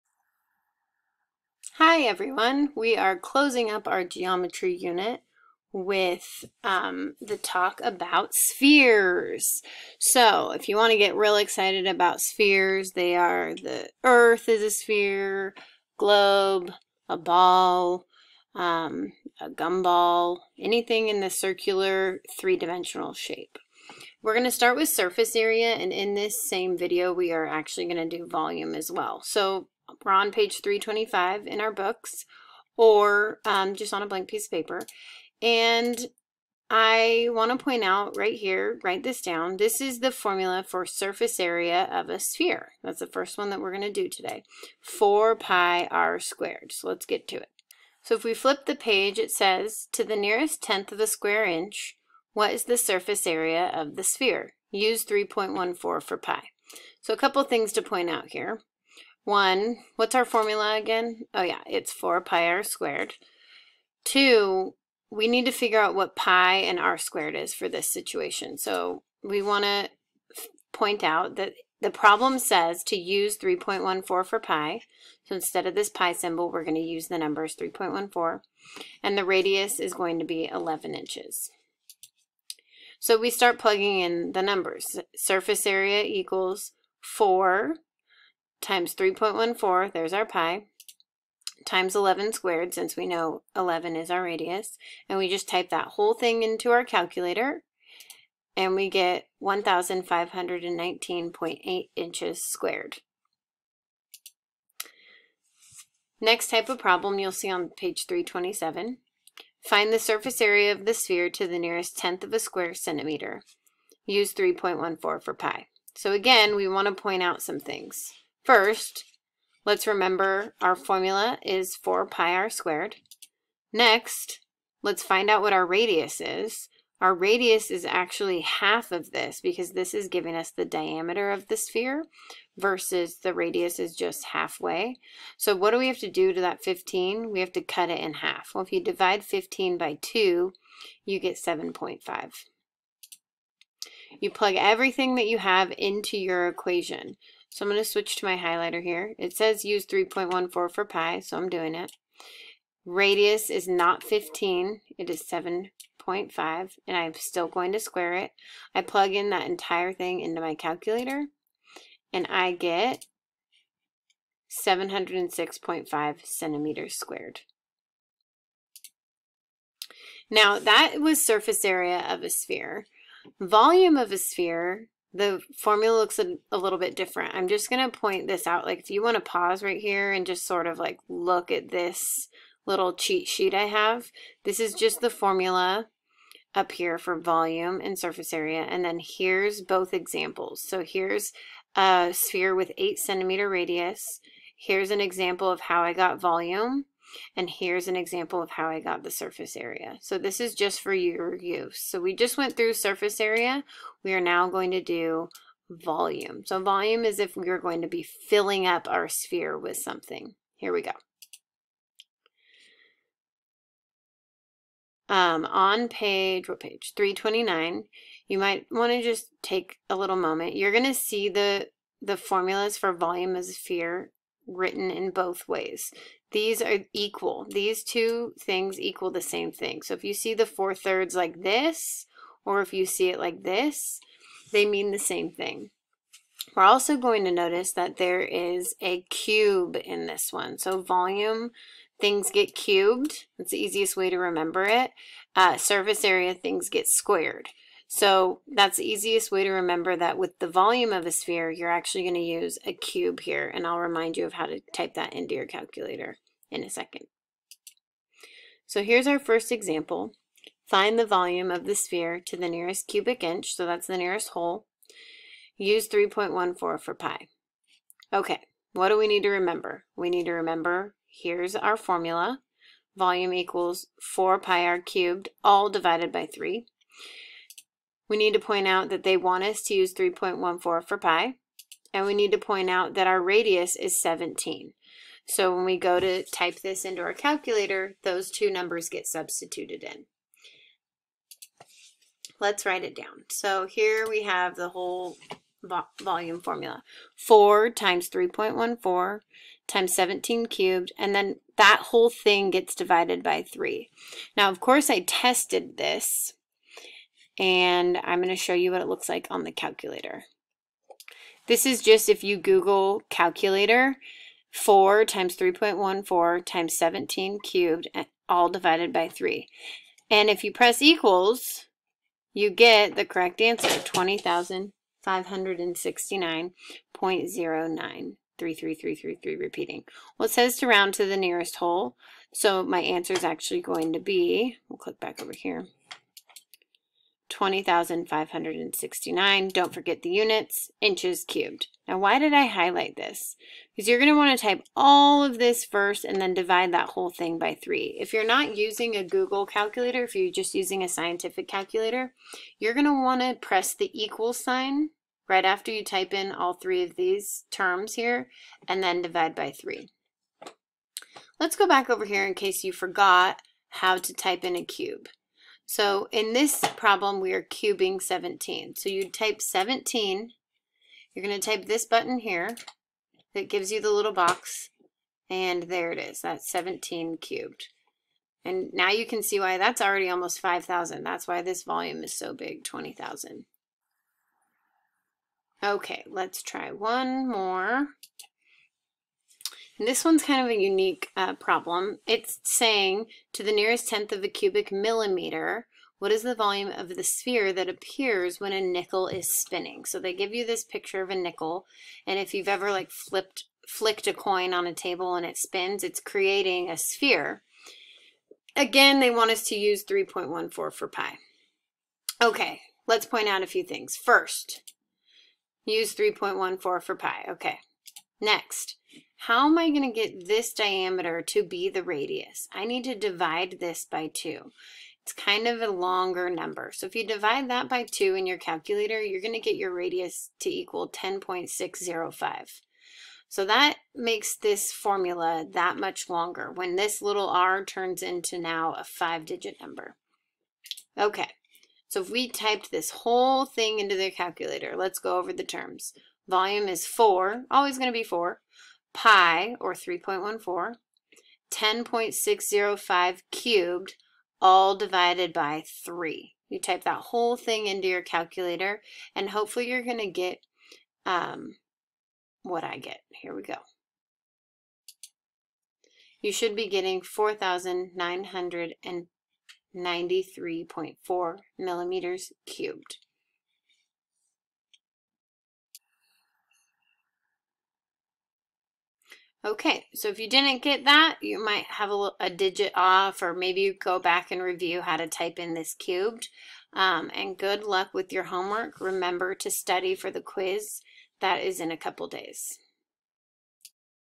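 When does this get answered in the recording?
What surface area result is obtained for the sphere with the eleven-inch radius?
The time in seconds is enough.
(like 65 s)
99 s.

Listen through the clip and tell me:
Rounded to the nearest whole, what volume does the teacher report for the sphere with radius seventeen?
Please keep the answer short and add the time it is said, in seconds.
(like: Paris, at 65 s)
20,569 cubic inches, at 337 s.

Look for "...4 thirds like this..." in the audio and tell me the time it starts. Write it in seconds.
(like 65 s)
230 s.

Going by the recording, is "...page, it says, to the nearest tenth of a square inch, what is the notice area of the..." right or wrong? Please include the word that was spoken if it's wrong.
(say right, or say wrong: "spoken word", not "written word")
wrong: "surface", not "notice".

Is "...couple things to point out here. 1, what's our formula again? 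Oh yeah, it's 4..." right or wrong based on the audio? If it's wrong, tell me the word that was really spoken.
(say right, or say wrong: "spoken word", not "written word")
right.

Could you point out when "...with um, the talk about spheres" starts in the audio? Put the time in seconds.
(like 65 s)
5 s.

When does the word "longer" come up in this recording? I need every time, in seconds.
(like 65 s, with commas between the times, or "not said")
425 s, 436 s.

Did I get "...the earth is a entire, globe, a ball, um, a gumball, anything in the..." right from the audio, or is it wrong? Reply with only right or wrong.
wrong.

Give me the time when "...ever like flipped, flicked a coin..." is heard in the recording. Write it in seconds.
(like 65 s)
402 s.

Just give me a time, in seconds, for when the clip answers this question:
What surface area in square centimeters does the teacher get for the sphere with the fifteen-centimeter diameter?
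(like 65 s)
164 s.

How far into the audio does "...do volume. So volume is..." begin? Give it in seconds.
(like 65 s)
204 s.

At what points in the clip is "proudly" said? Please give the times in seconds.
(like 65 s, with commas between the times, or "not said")
not said.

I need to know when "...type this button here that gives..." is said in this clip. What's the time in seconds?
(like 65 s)
371 s.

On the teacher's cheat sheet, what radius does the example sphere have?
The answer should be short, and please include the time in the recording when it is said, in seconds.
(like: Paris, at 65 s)
8 centimeters, at 192 s.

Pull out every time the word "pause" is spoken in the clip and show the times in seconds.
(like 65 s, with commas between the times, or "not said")
179 s.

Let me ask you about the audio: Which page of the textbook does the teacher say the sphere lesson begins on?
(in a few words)
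325.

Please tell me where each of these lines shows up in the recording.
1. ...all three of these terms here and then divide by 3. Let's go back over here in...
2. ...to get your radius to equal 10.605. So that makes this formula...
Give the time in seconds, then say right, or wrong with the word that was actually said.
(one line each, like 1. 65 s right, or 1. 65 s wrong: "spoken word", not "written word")
1. 356 s right
2. 429 s right.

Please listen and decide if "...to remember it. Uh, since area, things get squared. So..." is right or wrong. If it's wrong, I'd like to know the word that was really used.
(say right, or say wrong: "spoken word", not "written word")
wrong: "surface", not "since".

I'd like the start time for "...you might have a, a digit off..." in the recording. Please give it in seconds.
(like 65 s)
481 s.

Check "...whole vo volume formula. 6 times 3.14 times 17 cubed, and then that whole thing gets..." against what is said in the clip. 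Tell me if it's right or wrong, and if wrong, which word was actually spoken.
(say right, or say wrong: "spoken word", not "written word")
wrong: "4", not "6".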